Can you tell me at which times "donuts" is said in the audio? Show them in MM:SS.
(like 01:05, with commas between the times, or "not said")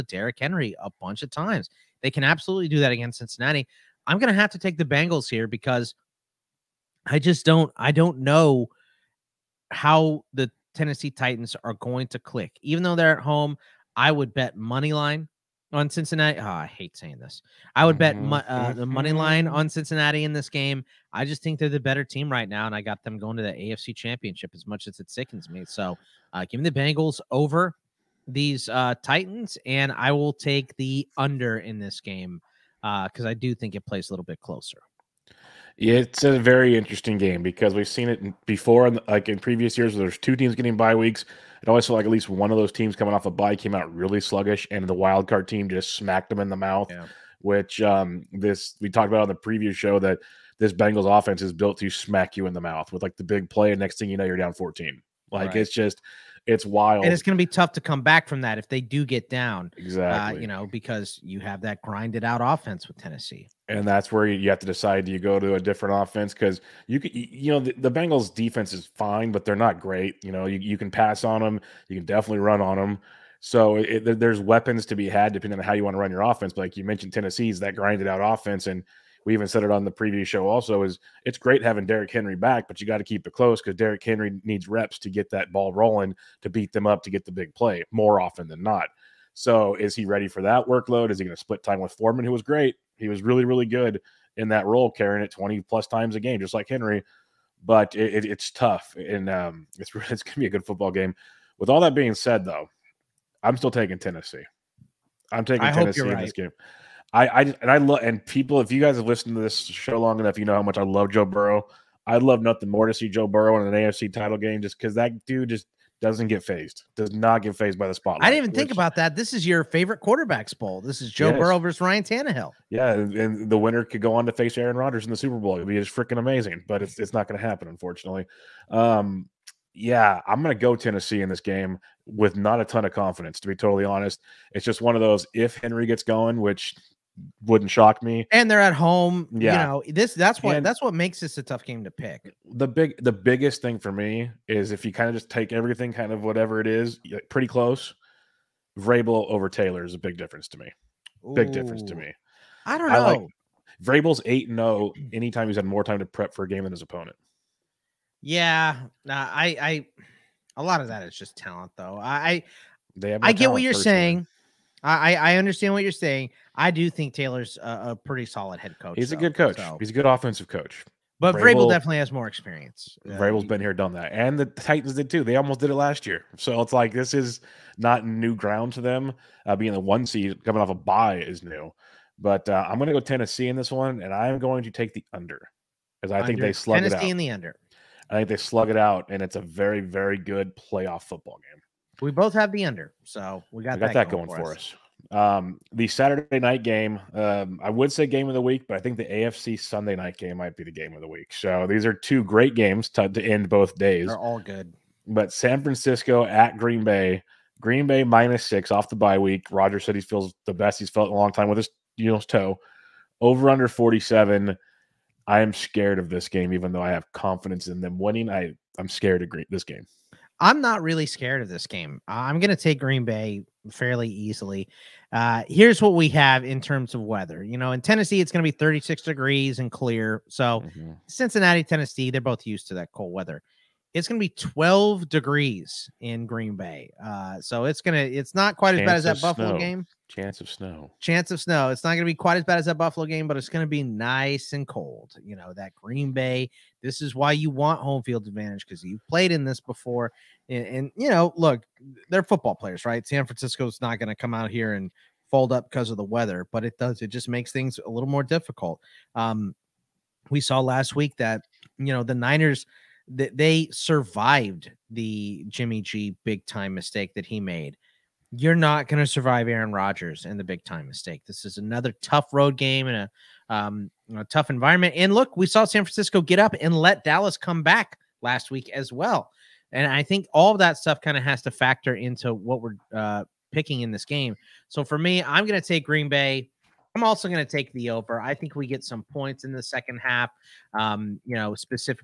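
not said.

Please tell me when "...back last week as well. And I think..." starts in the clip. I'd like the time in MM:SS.
04:37.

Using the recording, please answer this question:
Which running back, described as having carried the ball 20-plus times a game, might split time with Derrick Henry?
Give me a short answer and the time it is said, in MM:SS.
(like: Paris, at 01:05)
Foreman, at 01:31.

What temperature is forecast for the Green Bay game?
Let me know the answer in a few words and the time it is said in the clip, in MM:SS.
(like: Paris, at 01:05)
12 degrees, at 03:54.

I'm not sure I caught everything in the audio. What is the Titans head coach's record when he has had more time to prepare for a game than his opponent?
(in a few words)
8-0.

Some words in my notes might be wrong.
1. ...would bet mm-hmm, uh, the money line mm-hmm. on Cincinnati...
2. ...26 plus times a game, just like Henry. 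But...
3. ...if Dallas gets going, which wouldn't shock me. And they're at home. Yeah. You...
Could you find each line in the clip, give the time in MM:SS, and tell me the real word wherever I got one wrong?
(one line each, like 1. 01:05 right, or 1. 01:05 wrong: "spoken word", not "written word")
1. 00:17 right
2. 01:35 wrong: "20", not "26"
3. 02:15 wrong: "Henry", not "Dallas".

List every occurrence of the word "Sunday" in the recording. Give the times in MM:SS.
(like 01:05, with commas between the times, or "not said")
03:19.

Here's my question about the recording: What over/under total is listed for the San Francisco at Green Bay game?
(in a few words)
47.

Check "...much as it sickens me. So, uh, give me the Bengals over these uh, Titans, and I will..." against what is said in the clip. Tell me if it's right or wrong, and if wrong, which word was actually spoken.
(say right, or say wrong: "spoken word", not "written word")
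right.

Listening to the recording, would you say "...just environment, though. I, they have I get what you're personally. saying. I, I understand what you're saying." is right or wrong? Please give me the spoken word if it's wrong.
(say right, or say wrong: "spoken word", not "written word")
wrong: "talent", not "environment".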